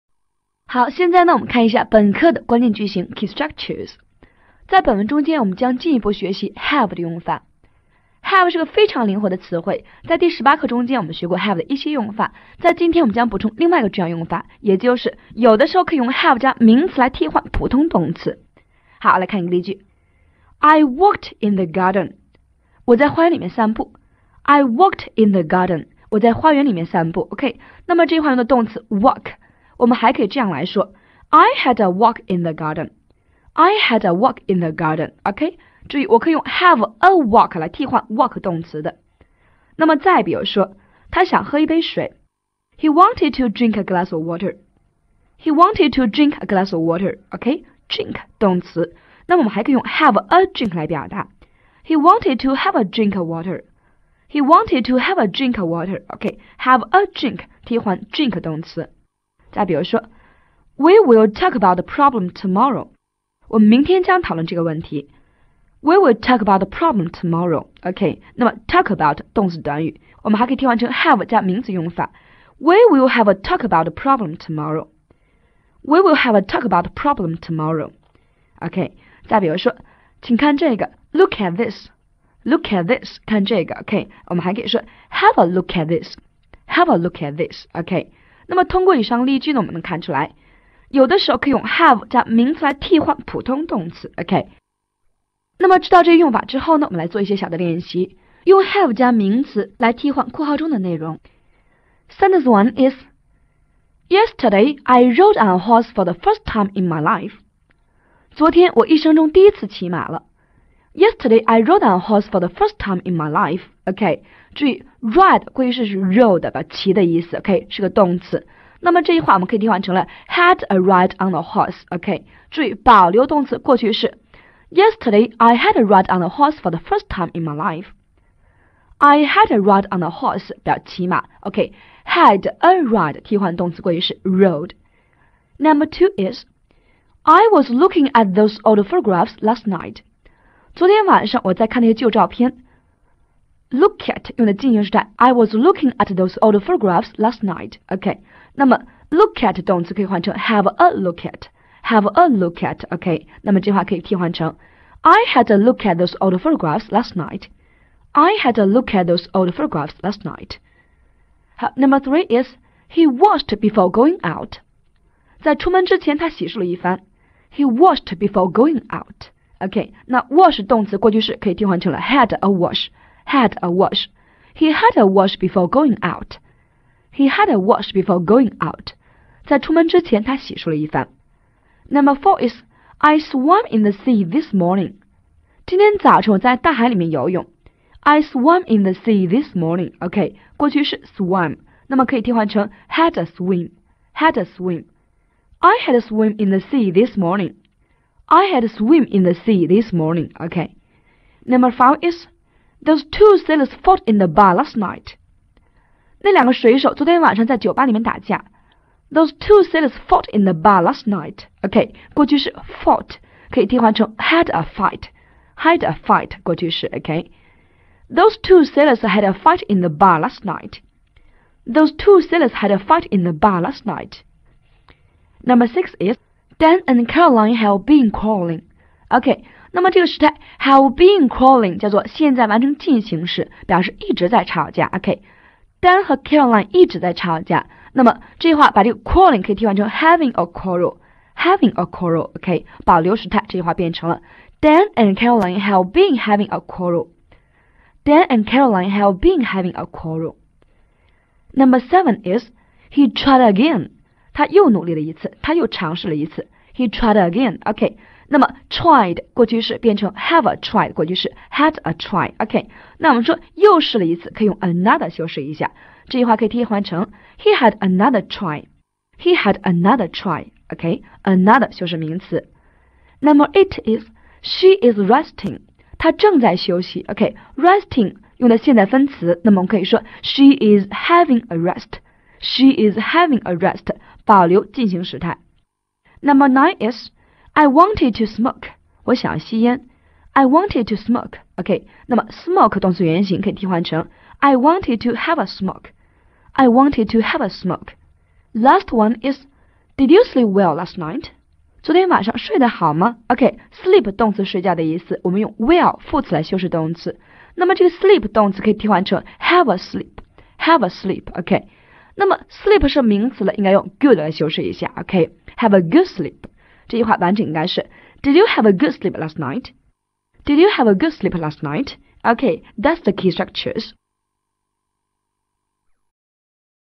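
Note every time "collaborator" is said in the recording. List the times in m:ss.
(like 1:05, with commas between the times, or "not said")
not said.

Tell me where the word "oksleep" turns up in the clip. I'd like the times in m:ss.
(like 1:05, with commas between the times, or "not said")
5:03.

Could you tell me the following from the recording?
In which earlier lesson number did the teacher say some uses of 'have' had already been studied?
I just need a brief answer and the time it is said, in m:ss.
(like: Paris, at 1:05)
18, at 0:10.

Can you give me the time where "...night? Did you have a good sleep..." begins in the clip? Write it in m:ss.
5:19.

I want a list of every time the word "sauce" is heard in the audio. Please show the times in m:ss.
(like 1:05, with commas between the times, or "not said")
not said.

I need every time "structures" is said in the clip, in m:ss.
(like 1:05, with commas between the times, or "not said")
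0:03, 5:23.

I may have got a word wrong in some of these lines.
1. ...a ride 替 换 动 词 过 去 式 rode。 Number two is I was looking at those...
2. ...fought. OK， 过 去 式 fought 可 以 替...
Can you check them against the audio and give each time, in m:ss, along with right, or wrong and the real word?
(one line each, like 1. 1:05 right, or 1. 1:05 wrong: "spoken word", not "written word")
1. 2:12 right
2. 3:31 wrong: "night", not "fought".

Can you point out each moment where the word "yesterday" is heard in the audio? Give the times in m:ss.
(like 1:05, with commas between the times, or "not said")
1:44, 1:50, 2:04.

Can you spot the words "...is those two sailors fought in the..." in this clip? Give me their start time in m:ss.
3:22.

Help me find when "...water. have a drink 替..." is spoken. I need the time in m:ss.
0:55.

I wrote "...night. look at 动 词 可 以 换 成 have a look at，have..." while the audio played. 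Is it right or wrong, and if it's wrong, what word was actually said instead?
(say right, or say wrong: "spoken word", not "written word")
right.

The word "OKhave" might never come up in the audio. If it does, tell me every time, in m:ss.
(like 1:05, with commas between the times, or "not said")
5:14.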